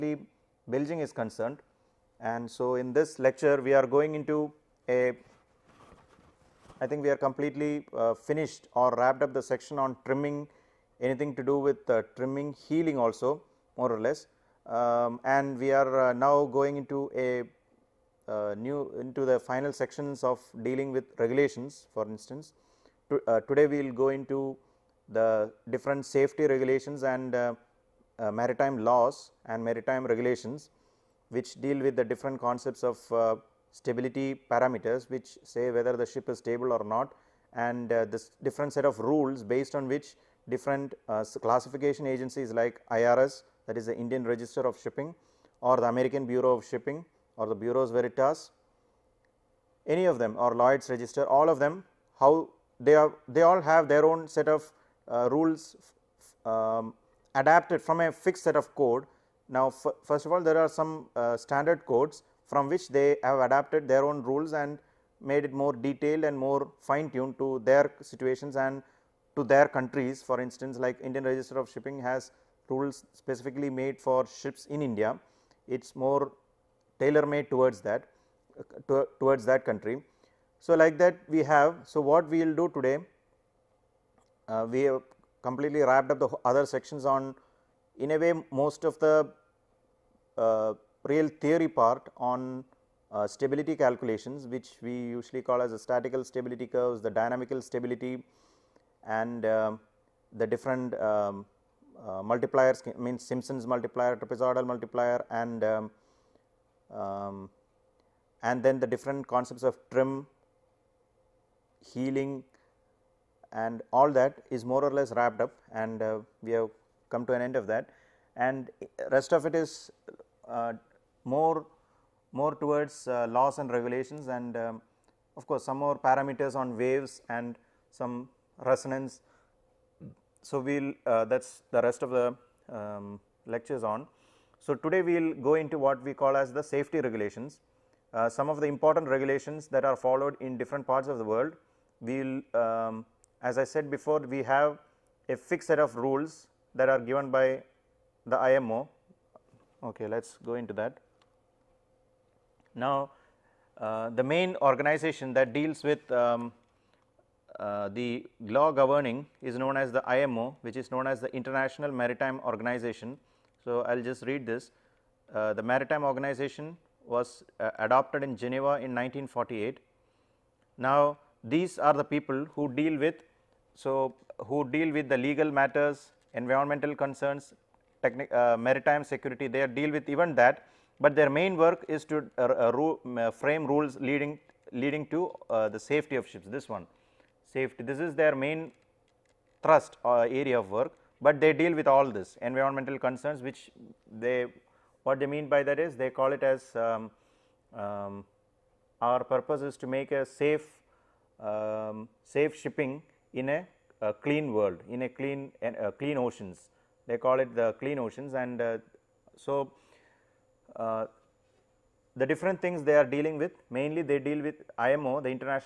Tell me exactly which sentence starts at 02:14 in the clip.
So today we'll go into what we call as the safety regulations.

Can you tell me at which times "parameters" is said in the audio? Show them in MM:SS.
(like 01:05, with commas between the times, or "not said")
00:34, 02:05.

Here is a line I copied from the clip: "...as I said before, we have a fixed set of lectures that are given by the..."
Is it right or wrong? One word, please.
wrong.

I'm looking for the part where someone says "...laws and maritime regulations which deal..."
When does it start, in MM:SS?
00:28.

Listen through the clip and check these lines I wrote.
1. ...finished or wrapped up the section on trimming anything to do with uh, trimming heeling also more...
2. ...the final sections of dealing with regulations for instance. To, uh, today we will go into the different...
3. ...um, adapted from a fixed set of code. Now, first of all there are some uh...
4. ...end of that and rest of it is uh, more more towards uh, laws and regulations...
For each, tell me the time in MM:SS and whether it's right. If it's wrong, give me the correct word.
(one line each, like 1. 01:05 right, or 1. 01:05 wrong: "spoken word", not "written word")
1. 00:08 right
2. 00:19 right
3. 00:56 right
4. 01:57 right.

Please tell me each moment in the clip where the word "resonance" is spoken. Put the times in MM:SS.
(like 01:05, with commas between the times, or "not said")
02:08.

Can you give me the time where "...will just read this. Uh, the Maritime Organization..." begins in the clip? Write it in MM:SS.
02:43.